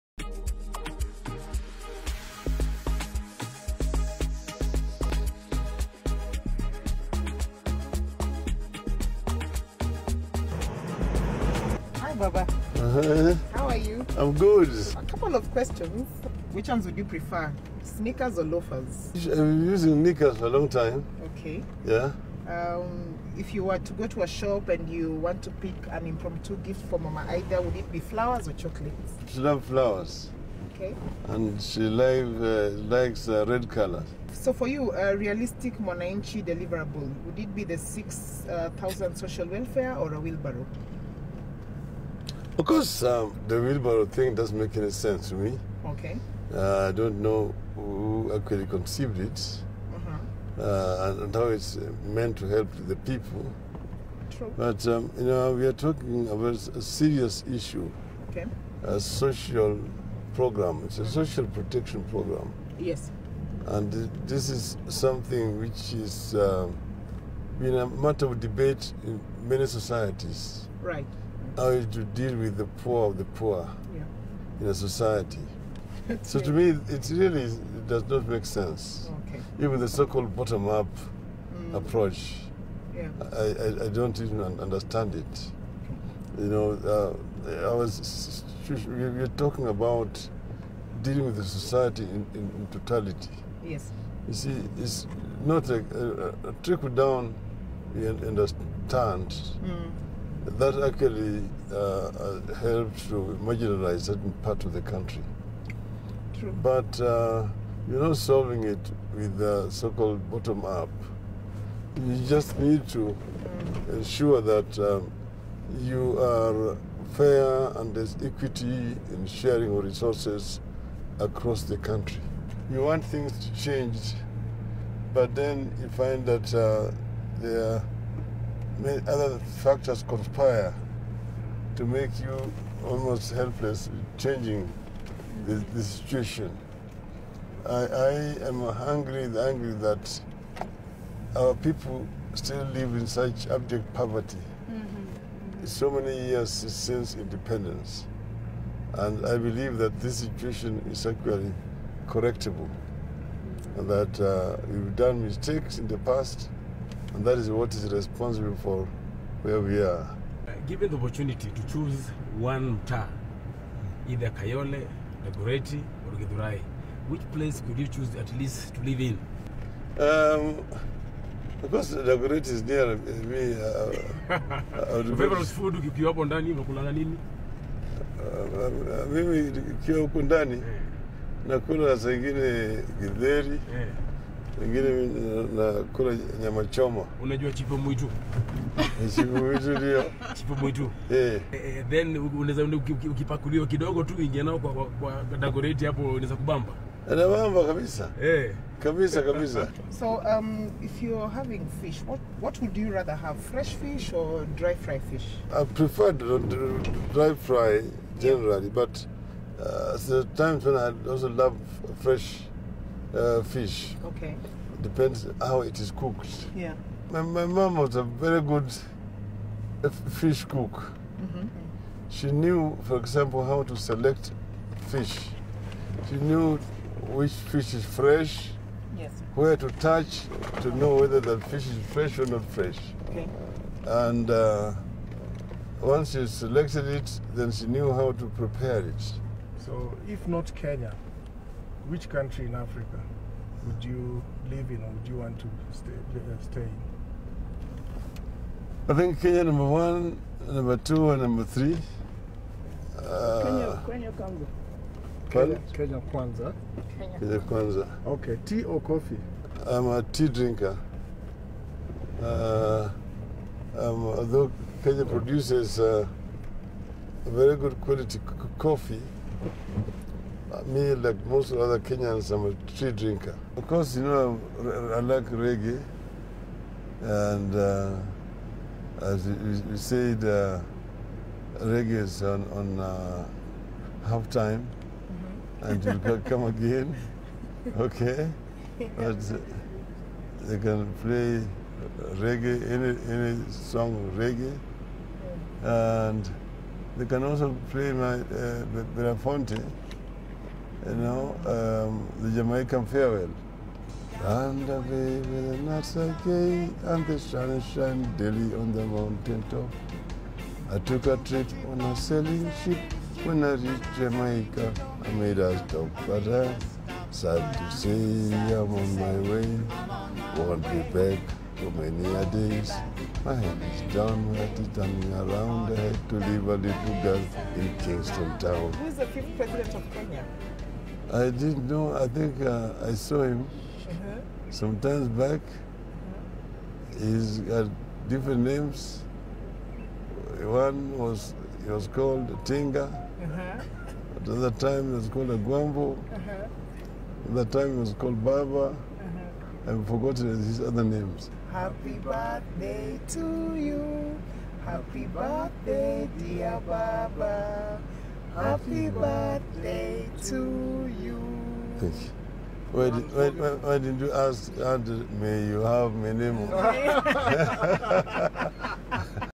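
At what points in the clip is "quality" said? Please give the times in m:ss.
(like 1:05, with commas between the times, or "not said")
4:27.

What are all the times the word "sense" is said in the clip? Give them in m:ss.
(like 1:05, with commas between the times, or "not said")
0:44, 1:18.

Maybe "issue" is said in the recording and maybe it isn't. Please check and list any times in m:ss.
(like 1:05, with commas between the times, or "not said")
0:57.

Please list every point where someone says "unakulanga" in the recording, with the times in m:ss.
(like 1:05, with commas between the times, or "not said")
2:56.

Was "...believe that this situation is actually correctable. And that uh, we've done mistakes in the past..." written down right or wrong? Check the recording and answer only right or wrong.
right.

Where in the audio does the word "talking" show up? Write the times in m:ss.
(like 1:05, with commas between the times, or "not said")
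0:55, 1:29.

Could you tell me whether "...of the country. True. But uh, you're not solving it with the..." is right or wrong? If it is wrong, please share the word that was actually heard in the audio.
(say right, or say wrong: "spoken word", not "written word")
right.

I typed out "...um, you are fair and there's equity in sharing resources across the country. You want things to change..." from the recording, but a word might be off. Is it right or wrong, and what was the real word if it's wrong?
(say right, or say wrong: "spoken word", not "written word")
right.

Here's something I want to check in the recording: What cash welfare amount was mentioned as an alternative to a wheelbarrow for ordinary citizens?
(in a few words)
6,000.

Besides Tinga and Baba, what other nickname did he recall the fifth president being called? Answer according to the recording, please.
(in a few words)
Agwambo.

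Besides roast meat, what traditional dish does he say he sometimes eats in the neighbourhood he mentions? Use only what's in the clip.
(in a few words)
githeri.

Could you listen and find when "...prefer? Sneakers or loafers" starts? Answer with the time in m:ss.
0:17.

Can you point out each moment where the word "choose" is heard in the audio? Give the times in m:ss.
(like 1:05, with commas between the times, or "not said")
2:41, 2:47.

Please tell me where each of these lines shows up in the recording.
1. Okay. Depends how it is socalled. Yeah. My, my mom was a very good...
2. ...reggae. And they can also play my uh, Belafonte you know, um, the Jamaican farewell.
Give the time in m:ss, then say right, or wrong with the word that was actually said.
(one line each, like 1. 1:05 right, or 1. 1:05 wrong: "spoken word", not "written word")
1. 3:34 wrong: "cooked", not "socalled"
2. 4:54 right.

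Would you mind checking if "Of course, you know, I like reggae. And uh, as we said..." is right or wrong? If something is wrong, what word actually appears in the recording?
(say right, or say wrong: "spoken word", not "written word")
right.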